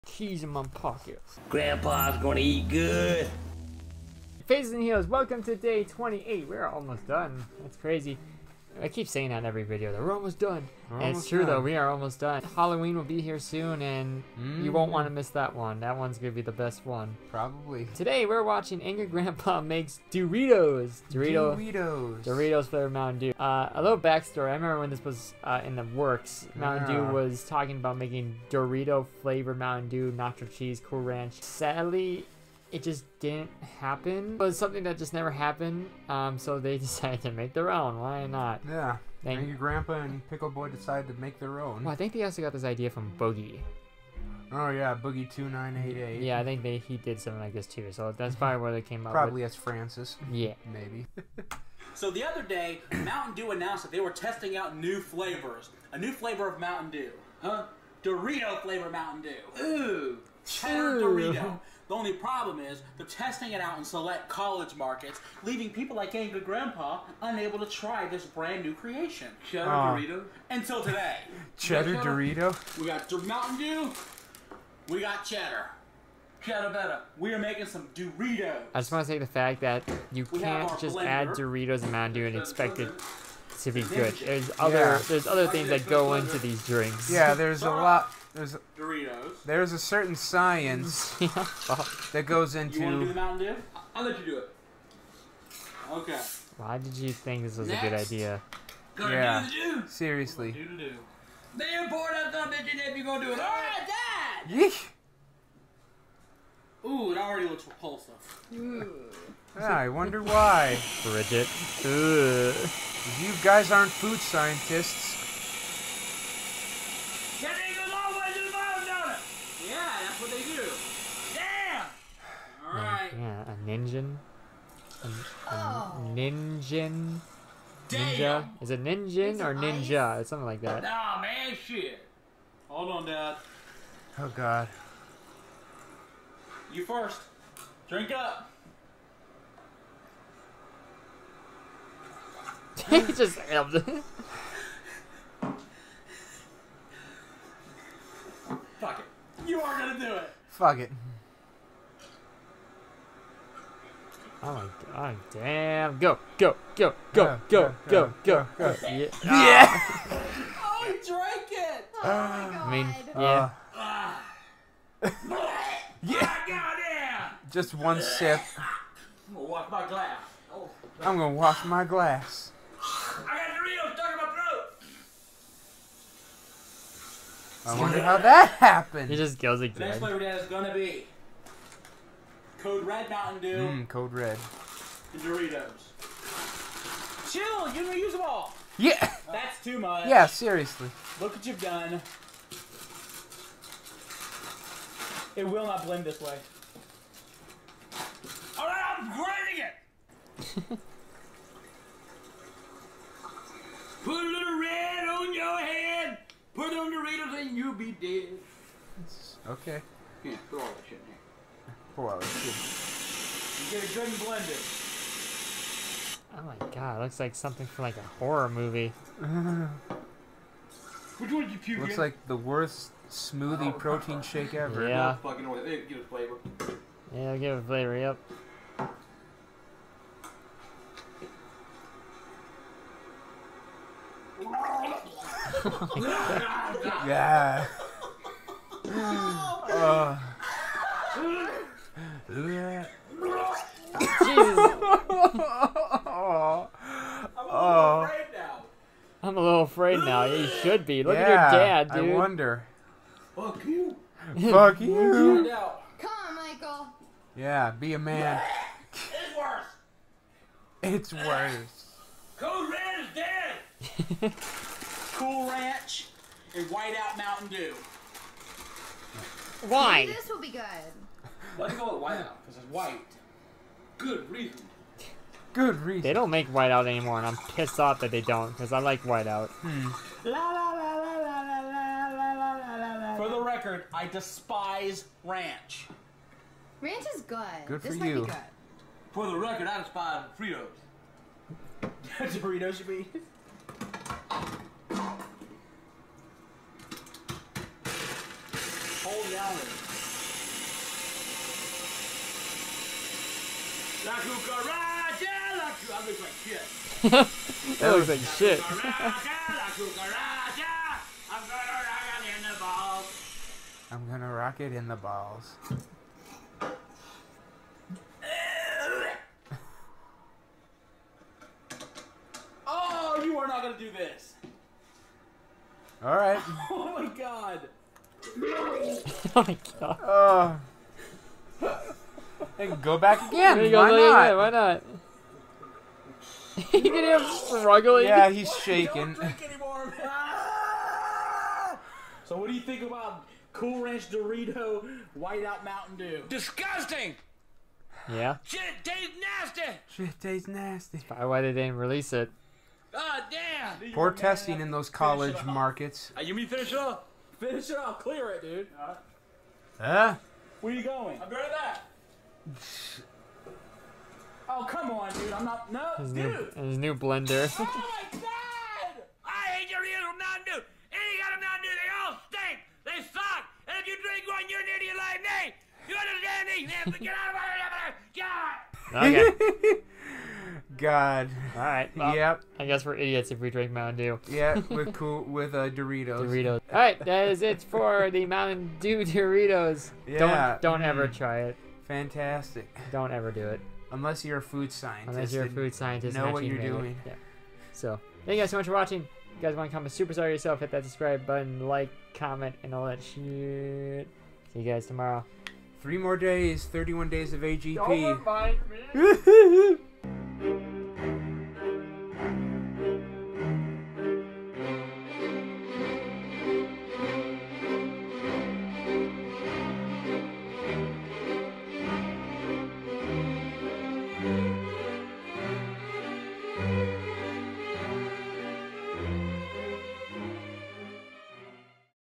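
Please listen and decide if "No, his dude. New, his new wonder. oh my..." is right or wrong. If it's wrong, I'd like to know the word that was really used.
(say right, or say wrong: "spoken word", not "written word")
wrong: "blender", not "wonder".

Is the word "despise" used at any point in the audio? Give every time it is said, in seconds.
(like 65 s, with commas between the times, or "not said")
284 s, 289 s.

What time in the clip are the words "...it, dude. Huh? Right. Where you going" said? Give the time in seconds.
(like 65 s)
358 s.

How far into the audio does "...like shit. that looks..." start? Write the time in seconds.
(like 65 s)
307 s.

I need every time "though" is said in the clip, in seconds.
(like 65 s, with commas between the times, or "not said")
11 s.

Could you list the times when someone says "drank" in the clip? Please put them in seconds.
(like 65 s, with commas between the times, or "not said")
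161 s.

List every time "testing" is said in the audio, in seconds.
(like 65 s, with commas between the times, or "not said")
54 s, 63 s, 354 s.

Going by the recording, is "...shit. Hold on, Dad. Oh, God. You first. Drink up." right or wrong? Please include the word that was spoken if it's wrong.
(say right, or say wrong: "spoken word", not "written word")
right.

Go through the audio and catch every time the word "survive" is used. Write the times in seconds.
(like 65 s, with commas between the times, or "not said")
not said.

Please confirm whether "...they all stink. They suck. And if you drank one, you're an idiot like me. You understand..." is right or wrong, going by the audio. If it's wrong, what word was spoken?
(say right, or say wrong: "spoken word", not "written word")
wrong: "drink", not "drank".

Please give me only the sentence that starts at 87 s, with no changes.
Yeah, there's a lot there's a, Doritos.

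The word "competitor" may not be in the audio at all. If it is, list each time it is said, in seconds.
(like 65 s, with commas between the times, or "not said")
not said.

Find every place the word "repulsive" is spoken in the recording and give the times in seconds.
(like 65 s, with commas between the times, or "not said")
107 s.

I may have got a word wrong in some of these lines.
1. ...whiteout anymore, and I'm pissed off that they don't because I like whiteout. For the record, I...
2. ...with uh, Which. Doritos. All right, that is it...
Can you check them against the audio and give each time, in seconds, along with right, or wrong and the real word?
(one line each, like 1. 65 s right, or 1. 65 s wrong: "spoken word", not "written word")
1. 276 s right
2. 385 s wrong: "Doritos", not "Which".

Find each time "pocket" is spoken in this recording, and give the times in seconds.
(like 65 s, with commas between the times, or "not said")
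0 s.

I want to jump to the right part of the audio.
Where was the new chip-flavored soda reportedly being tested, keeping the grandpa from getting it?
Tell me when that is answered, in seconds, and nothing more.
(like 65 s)
63 s.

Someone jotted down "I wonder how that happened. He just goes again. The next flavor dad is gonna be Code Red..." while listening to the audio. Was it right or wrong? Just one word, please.
right.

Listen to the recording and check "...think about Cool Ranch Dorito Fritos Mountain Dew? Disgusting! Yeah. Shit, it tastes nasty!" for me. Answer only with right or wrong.
wrong.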